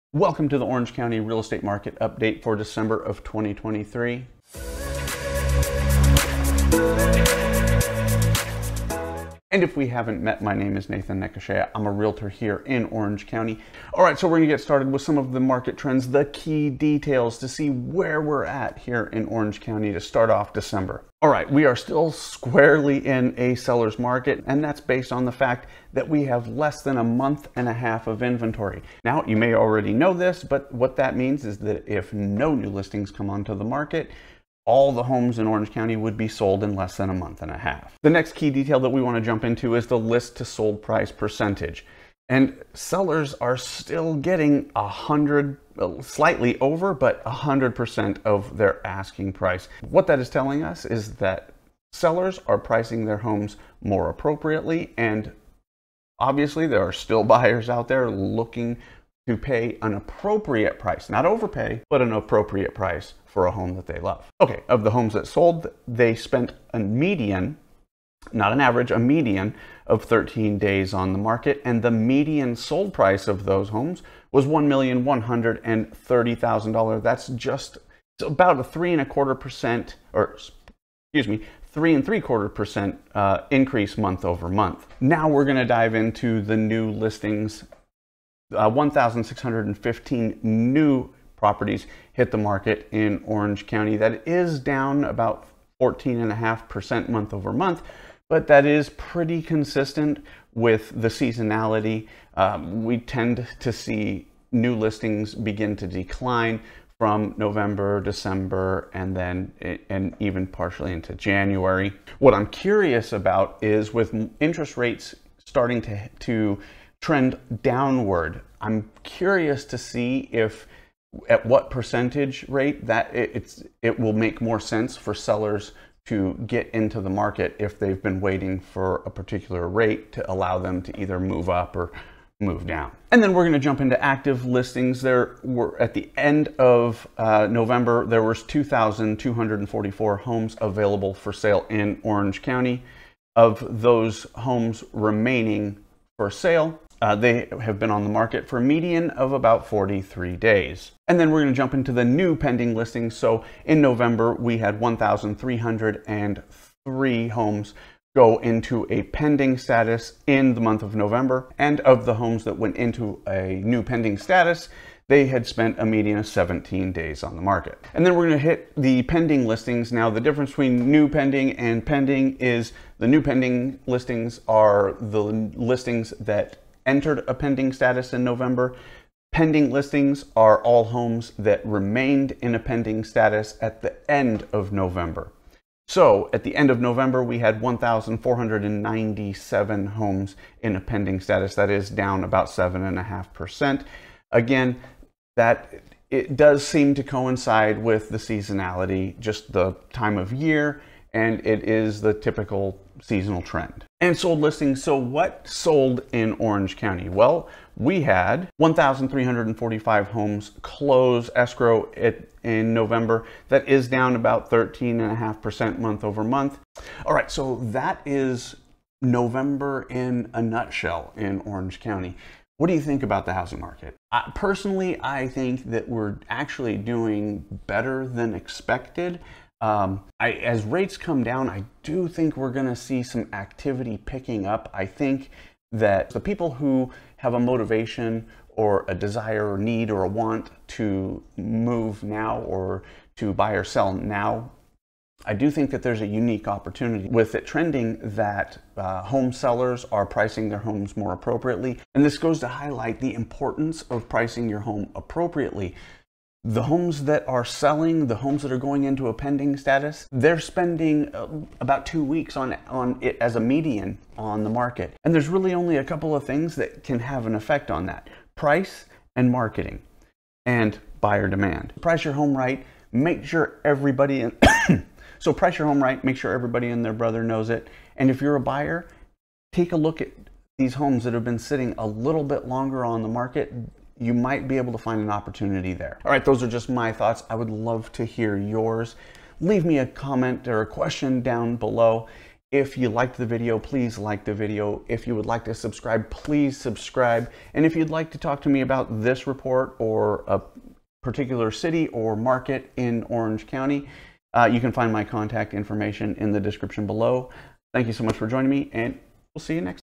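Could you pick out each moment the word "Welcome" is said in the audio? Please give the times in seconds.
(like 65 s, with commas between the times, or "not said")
0 s.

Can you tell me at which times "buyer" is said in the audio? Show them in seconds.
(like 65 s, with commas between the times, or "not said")
57 s, 270 s, 278 s.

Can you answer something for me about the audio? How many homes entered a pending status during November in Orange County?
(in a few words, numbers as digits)
1,303.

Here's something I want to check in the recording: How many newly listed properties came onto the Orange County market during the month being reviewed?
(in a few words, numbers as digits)
1,615.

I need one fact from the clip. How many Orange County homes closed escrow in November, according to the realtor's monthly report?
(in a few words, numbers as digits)
1,345.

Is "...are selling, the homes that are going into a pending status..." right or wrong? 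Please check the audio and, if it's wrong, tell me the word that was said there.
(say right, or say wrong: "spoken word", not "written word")
right.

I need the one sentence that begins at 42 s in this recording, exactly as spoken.
And sellers are still getting a hundred, slightly over, but a hundred percent of their asking price.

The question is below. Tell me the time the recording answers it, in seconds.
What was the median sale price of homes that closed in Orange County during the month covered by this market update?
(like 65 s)
74 s.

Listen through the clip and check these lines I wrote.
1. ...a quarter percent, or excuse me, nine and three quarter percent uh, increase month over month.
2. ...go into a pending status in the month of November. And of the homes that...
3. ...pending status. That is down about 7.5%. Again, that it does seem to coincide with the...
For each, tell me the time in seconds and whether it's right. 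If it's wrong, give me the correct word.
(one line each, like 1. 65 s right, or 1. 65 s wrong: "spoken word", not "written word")
1. 79 s wrong: "three", not "nine"
2. 158 s right
3. 190 s right.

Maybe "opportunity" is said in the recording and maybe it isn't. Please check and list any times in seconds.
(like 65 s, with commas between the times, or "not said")
246 s, 285 s.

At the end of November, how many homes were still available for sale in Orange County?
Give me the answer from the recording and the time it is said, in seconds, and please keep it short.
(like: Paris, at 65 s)
2,244, at 138 s.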